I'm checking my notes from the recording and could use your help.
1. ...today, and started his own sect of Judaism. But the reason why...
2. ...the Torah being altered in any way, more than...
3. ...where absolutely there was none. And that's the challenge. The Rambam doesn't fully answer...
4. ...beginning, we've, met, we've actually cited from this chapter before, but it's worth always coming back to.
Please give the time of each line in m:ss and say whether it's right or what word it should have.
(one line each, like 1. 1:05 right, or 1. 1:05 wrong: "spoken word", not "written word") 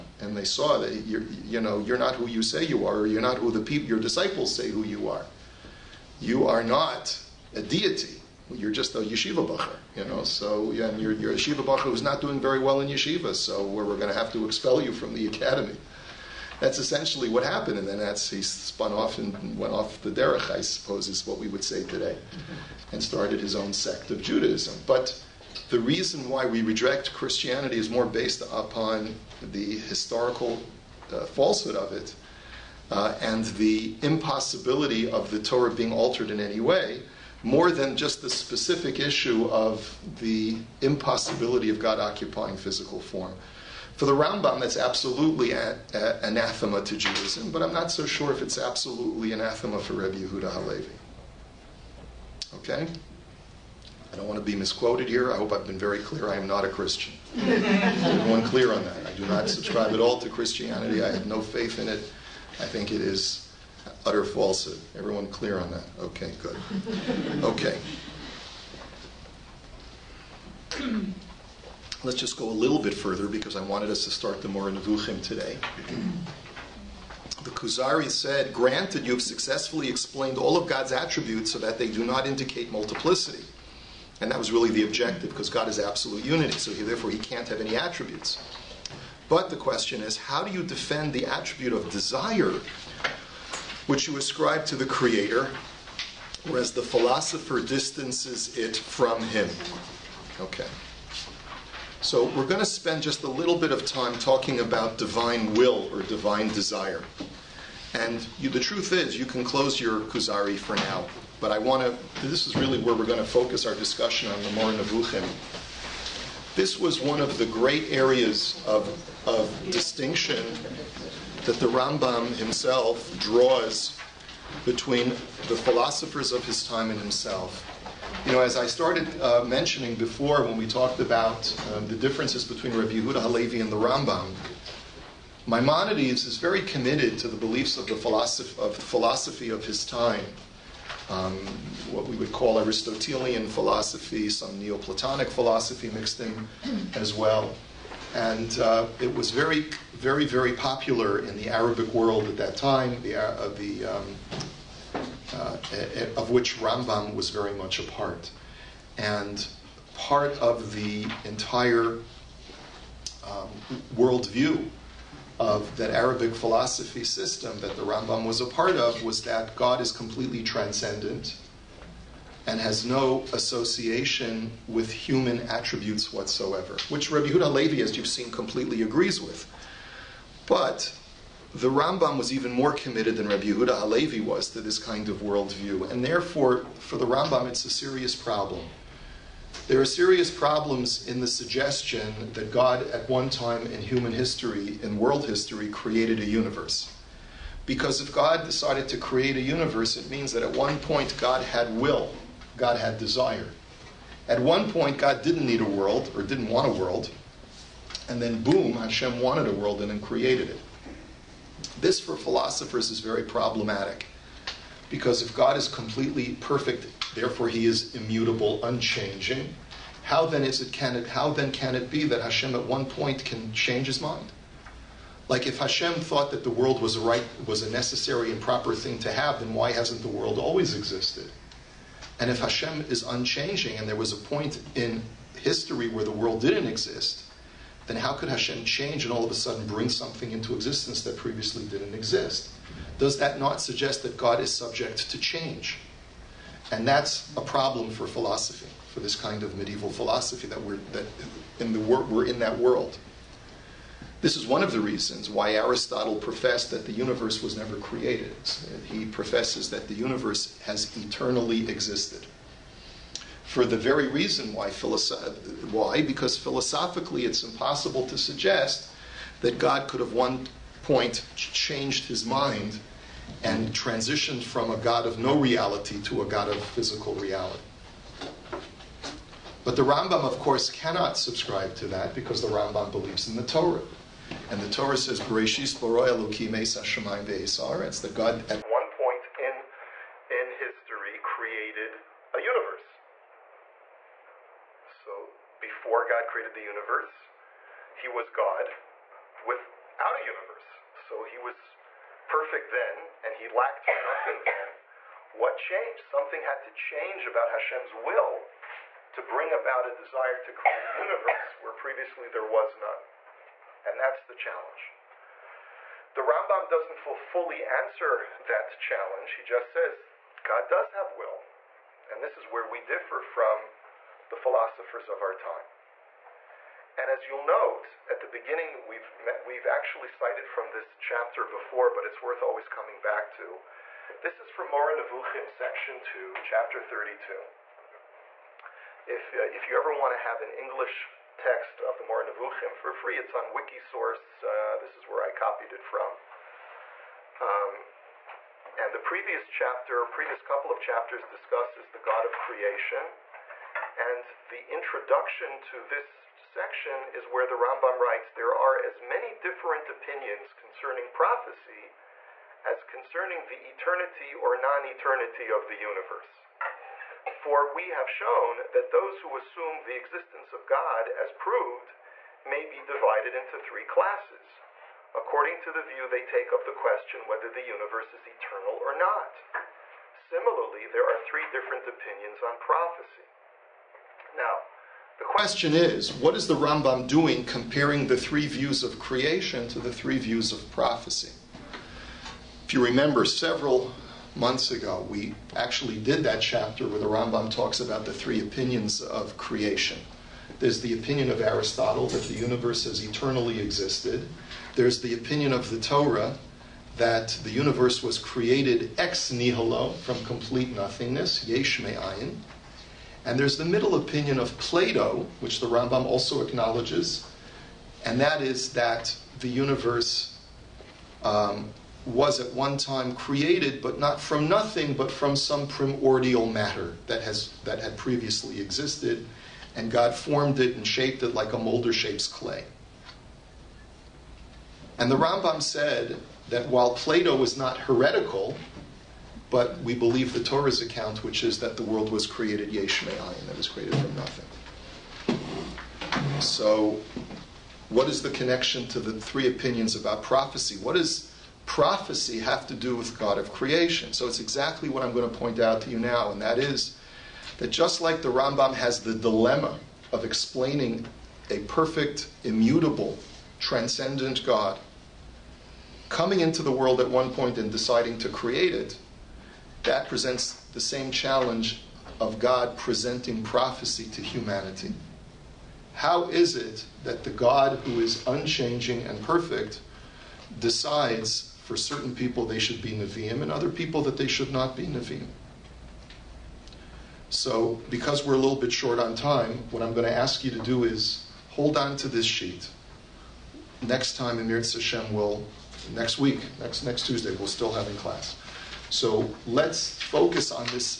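1. 0:21 right
2. 0:35 right
3. 5:11 wrong: "previously", not "absolutely"
4. 5:28 right.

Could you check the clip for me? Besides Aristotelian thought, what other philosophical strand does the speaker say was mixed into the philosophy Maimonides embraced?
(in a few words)
Neoplatonic philosophy.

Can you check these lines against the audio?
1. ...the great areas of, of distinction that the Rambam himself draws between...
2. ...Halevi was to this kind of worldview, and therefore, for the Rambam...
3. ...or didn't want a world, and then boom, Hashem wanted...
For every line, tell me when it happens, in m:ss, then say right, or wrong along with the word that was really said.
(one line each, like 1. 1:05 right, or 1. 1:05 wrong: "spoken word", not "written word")
1. 1:57 right
2. 3:03 right
3. 3:26 right.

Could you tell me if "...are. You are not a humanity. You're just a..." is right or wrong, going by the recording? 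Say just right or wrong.
wrong.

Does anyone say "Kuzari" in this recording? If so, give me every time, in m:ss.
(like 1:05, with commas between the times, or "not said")
1:17, 1:49.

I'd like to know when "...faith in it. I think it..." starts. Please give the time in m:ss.
1:01.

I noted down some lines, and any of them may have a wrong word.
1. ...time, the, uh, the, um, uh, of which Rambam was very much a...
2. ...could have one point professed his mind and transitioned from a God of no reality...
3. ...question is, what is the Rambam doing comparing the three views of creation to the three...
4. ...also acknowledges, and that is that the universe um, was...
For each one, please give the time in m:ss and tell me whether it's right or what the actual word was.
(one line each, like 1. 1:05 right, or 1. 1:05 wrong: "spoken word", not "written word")
1. 2:32 right
2. 4:29 wrong: "changed", not "professed"
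3. 6:25 right
4. 6:56 right.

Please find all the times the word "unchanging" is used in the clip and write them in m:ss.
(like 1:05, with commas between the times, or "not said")
3:38, 3:53, 7:58.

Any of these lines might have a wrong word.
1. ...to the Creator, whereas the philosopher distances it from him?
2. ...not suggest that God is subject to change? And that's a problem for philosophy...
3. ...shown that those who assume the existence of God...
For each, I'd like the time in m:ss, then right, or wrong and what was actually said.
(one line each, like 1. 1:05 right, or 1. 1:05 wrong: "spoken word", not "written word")
1. 1:34 right
2. 4:03 right
3. 6:08 right.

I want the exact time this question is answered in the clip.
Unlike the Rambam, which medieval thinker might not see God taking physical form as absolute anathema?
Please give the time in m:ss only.
0:49.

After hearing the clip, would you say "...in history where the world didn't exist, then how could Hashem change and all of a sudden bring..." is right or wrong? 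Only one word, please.
right.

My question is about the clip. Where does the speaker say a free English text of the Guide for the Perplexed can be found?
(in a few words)
Wikisource.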